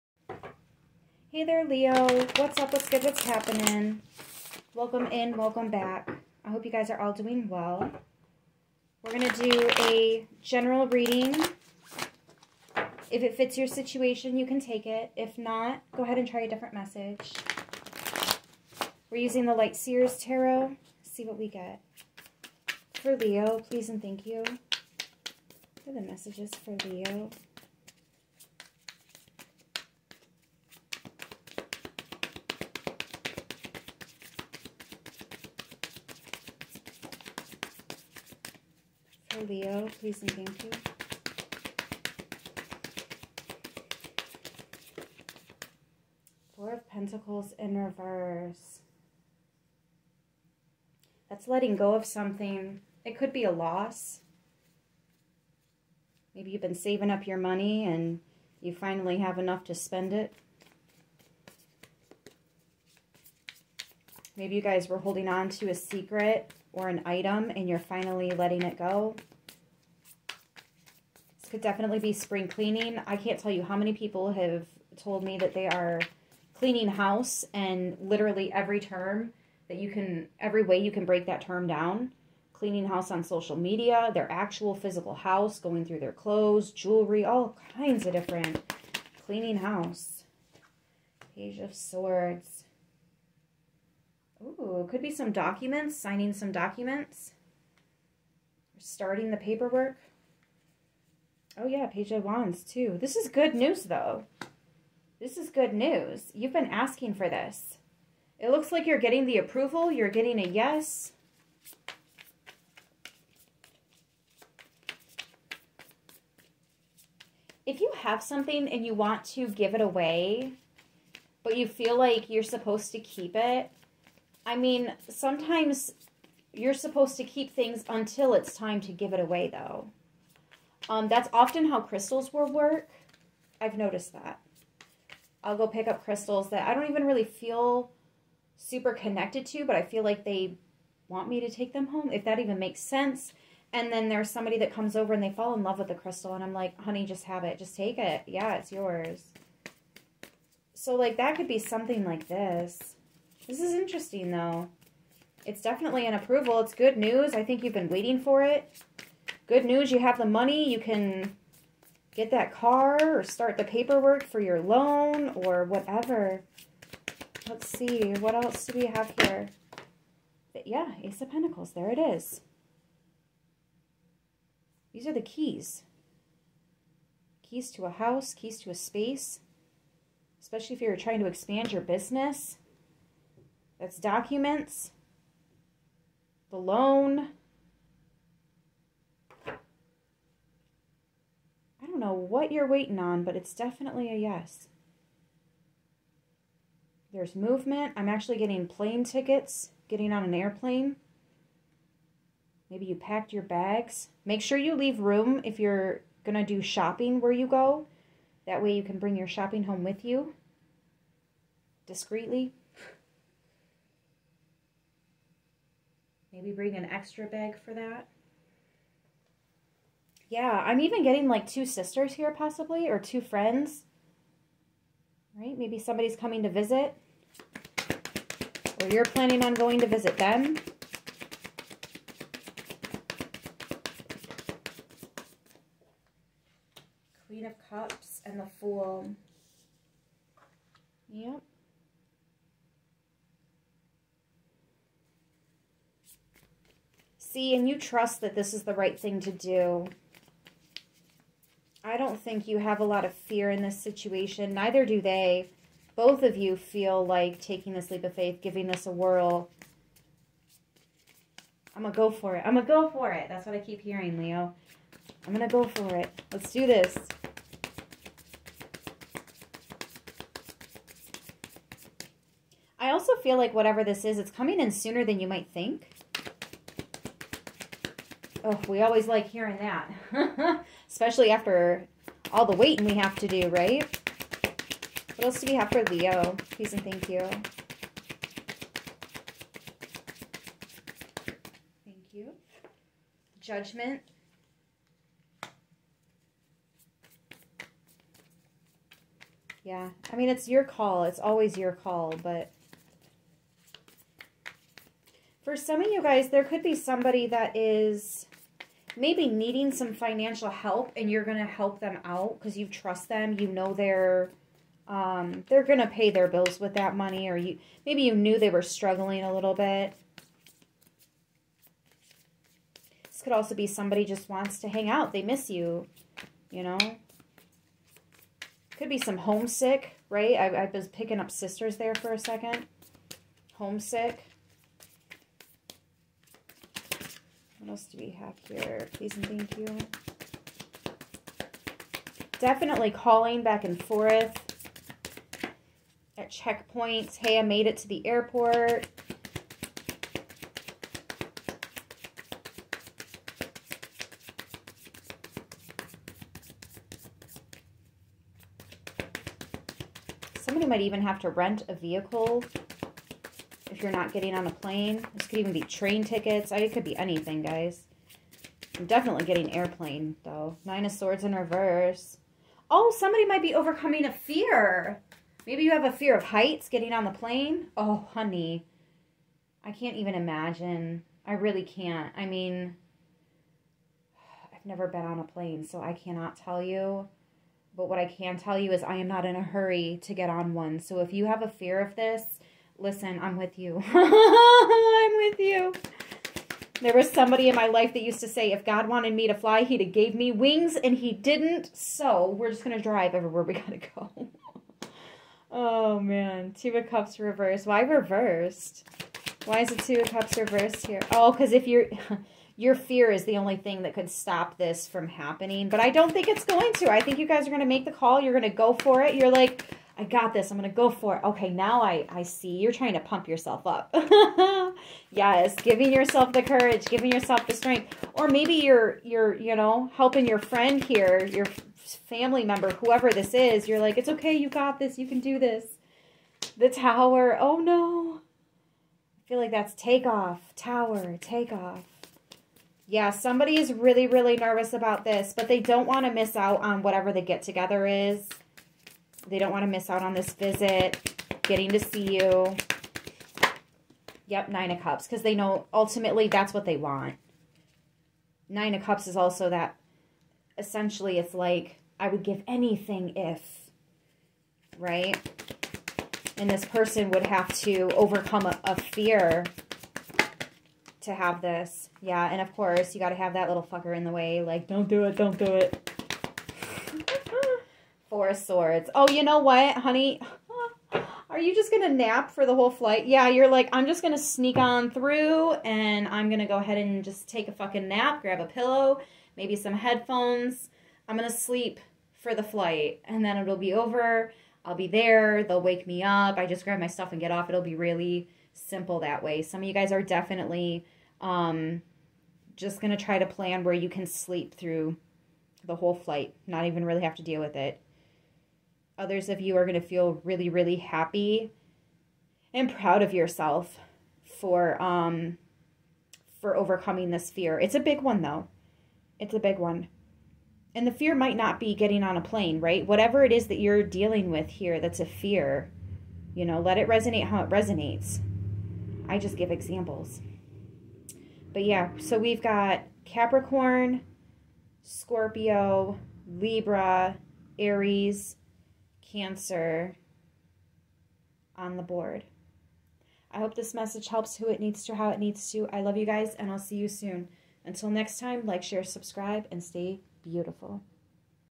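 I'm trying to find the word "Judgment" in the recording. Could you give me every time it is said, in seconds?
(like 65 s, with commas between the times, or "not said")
293 s.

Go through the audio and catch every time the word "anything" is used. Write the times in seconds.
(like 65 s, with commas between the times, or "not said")
366 s, 462 s.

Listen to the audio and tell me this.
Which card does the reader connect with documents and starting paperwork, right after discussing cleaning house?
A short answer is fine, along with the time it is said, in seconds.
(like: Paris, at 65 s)
Page of Swords, at 91 s.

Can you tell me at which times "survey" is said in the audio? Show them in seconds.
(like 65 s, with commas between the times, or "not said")
not said.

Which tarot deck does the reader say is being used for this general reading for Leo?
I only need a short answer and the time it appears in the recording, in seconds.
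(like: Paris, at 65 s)
Light Seers Tarot, at 19 s.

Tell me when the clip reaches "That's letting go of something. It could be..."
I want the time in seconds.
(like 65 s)
51 s.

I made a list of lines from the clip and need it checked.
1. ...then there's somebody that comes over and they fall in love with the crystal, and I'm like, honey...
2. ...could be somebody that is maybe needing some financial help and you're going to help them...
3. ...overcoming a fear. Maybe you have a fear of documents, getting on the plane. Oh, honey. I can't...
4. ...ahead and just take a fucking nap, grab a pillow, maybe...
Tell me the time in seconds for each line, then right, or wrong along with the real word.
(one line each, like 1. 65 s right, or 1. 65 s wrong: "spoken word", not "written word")
1. 143 s right
2. 306 s right
3. 373 s wrong: "heights", not "documents"
4. 486 s right.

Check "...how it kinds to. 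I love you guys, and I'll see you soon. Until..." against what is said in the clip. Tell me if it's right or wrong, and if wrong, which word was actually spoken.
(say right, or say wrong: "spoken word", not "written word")
wrong: "needs", not "kinds".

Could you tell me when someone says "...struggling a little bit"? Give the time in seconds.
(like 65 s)
318 s.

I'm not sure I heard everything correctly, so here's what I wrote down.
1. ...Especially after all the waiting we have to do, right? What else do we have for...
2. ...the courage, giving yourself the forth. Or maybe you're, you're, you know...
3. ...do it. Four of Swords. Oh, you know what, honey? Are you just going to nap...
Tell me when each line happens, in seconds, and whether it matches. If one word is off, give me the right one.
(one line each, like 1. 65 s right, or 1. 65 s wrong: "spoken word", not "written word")
1. 280 s right
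2. 426 s wrong: "strength", not "forth"
3. 475 s right.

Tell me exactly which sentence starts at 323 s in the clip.
This could also be somebody just wants to hang out.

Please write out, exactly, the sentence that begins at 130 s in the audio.
Um, that's often how crystals will work.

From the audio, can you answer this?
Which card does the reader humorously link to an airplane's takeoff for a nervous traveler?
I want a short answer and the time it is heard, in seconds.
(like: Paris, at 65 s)
The Tower, at 436 s.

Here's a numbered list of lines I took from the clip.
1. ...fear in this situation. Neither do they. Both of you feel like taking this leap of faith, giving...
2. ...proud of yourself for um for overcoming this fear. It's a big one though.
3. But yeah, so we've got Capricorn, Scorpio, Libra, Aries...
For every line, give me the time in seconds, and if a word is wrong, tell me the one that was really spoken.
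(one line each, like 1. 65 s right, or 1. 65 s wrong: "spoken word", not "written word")
1. 253 s right
2. 512 s right
3. 531 s right.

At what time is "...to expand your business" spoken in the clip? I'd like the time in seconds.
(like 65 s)
181 s.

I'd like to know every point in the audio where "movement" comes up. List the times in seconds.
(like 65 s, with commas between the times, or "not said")
197 s.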